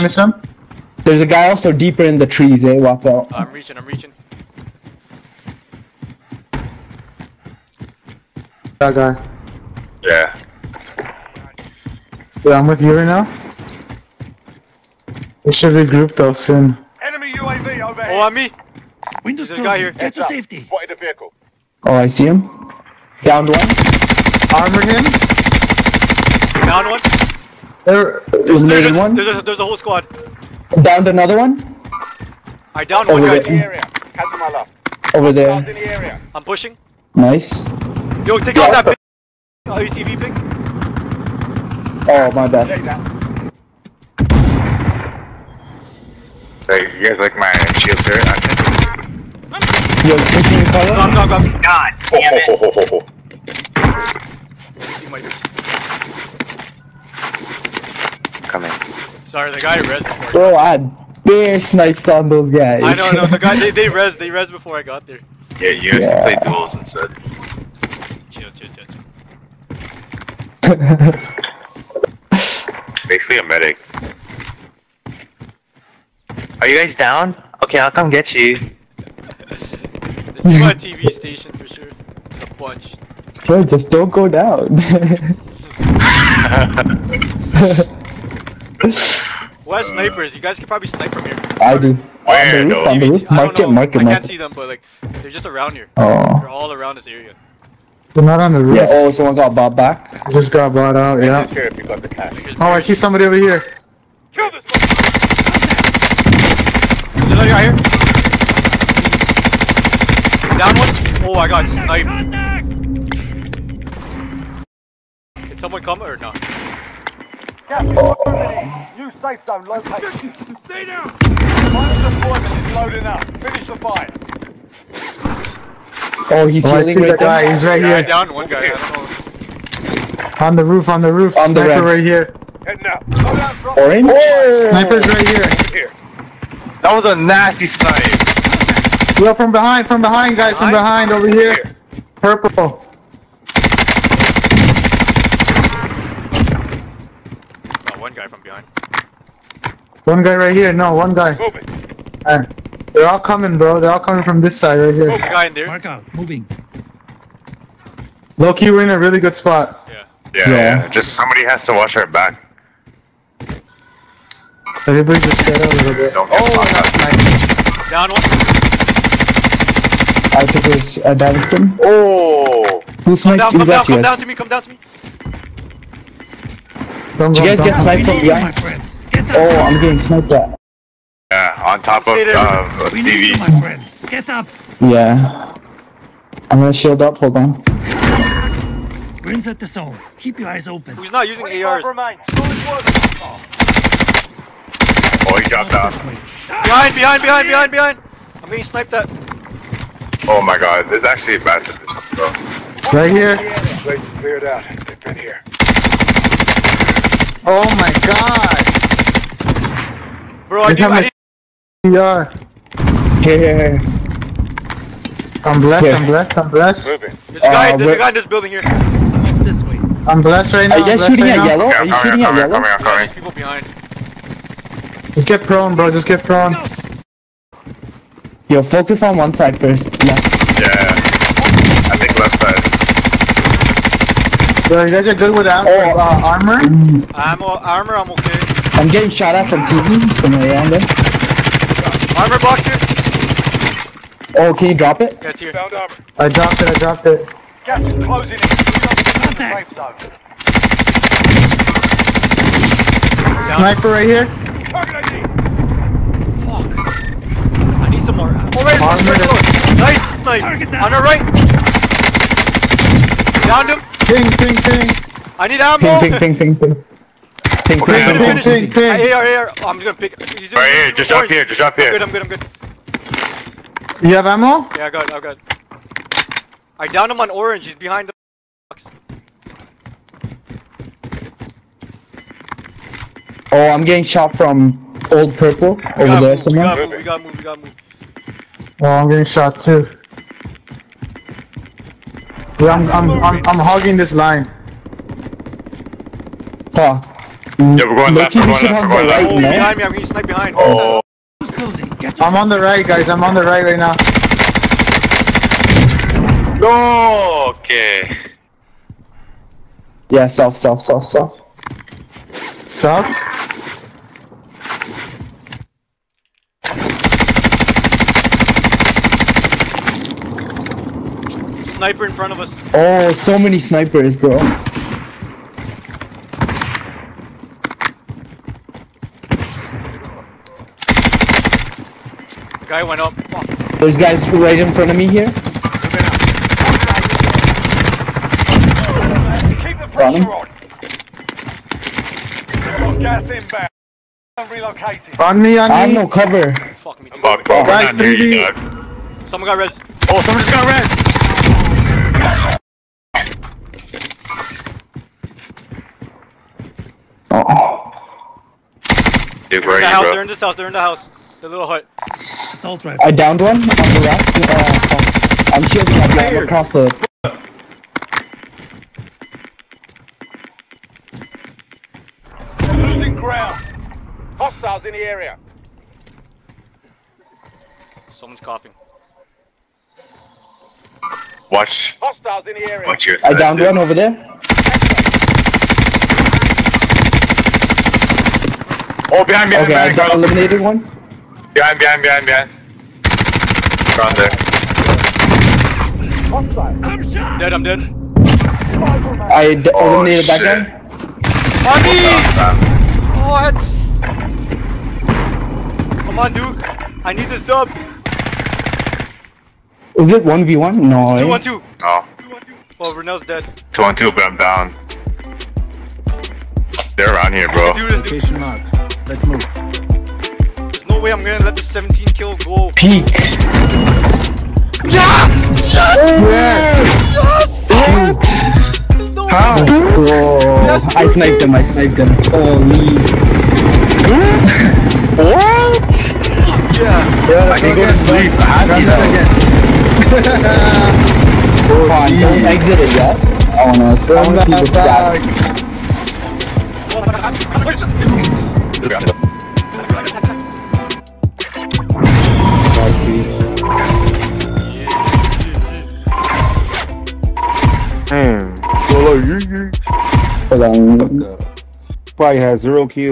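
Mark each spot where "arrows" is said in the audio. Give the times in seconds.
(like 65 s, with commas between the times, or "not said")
not said.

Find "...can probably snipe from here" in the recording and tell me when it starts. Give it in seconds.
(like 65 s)
90 s.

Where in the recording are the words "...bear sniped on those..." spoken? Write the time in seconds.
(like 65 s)
61 s.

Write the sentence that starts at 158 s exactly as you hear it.
Loki, we're in a really good spot.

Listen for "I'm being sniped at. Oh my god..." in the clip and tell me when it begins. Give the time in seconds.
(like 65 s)
198 s.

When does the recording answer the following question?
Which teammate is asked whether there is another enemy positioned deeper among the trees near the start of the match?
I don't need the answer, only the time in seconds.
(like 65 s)
2 s.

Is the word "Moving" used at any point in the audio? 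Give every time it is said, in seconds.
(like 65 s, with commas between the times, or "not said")
151 s, 156 s, 216 s.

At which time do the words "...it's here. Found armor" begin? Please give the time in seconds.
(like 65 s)
245 s.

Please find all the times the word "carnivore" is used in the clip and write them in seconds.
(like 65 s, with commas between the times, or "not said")
not said.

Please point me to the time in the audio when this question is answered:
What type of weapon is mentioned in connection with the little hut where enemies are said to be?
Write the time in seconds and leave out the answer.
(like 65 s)
362 s.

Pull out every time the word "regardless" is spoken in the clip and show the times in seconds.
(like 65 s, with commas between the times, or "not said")
not said.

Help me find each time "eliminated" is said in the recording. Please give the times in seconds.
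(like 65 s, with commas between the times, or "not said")
390 s, 399 s.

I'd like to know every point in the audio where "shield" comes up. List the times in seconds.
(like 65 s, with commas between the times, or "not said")
47 s, 186 s.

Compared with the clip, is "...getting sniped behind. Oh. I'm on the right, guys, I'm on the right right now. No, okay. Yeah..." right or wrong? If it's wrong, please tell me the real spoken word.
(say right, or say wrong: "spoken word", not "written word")
right.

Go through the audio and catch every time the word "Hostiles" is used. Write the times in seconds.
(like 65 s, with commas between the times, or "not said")
374 s, 382 s.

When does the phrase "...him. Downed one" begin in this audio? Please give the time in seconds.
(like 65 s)
22 s.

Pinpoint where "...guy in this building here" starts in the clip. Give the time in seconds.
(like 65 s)
217 s.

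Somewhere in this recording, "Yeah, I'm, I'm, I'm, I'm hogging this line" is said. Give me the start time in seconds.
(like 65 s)
292 s.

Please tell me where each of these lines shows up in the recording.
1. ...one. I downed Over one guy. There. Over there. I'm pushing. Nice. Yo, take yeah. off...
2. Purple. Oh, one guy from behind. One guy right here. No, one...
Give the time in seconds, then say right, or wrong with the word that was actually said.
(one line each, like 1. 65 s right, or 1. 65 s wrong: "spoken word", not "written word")
1. 31 s right
2. 142 s right.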